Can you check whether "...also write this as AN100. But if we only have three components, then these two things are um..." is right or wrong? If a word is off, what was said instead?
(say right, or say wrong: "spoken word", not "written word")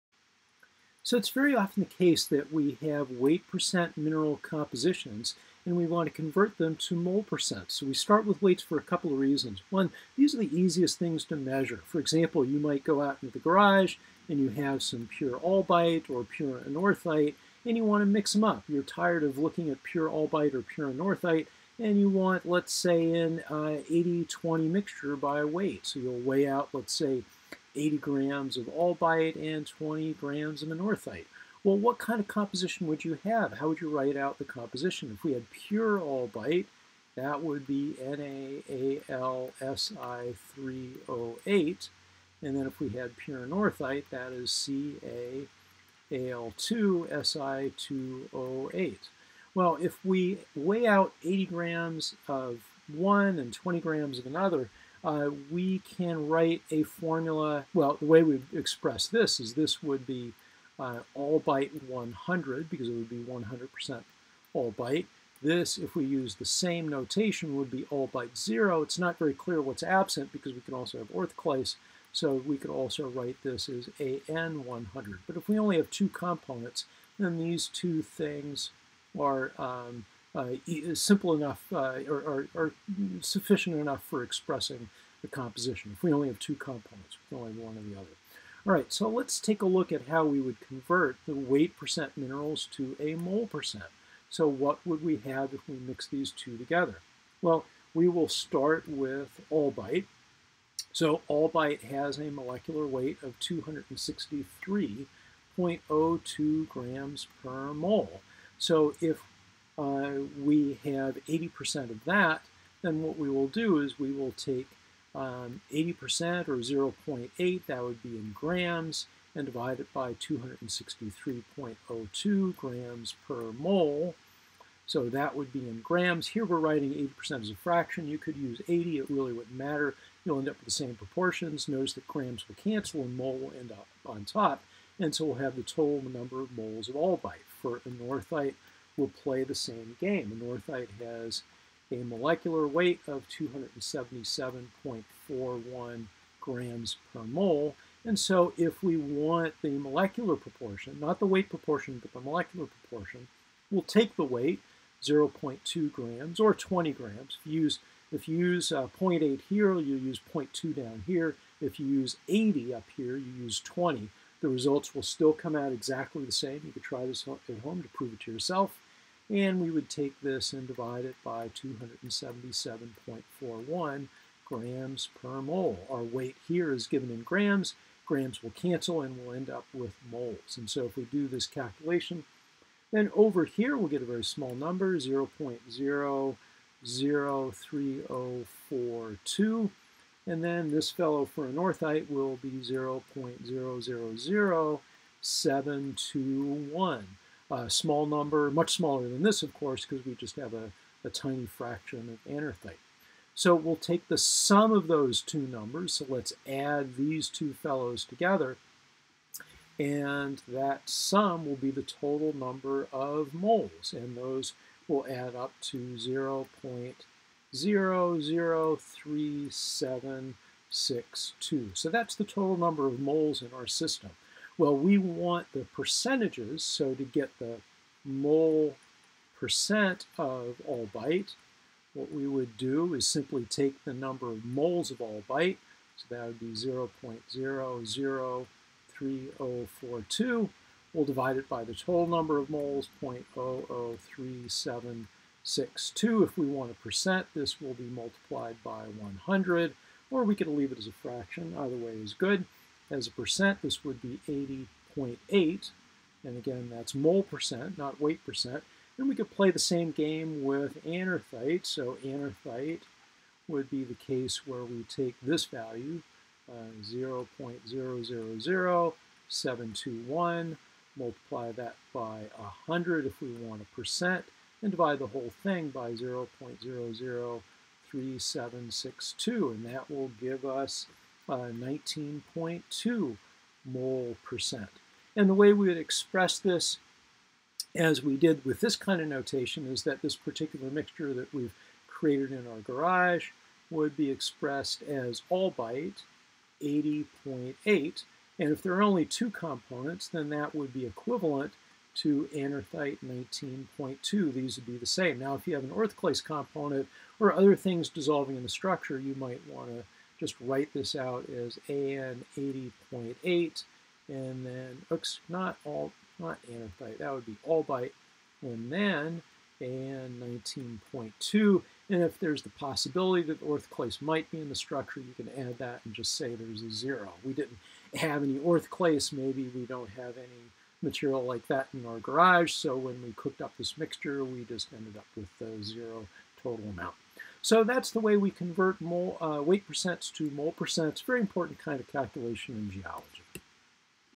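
wrong: "two", not "three".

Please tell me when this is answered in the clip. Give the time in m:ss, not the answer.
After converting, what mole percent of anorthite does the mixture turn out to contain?
4:41.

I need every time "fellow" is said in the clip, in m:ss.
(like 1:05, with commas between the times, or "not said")
3:10, 3:27.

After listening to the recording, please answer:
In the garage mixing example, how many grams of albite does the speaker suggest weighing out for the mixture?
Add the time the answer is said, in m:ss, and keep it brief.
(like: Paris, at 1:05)
80 grams, at 0:27.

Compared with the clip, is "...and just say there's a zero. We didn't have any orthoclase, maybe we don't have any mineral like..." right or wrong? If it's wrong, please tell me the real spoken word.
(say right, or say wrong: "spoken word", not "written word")
wrong: "material", not "mineral".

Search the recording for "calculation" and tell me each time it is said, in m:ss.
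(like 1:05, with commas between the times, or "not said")
3:01, 5:41.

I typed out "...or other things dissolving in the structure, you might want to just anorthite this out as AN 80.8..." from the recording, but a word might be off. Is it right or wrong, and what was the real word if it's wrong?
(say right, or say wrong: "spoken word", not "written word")
wrong: "write", not "anorthite".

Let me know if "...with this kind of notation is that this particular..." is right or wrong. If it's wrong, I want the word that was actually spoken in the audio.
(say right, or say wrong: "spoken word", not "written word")
right.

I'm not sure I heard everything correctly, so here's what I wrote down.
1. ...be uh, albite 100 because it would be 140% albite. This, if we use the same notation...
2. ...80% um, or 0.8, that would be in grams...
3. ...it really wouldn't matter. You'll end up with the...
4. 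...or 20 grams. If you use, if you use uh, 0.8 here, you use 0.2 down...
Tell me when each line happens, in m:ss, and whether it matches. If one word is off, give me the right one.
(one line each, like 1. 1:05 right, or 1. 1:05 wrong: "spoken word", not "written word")
1. 1:00 wrong: "100", not "140"
2. 1:55 right
3. 2:08 right
4. 2:36 right.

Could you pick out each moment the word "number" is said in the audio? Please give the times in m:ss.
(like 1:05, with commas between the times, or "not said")
2:16, 3:04, 3:18, 3:25, 3:32, 3:42, 3:53, 4:02.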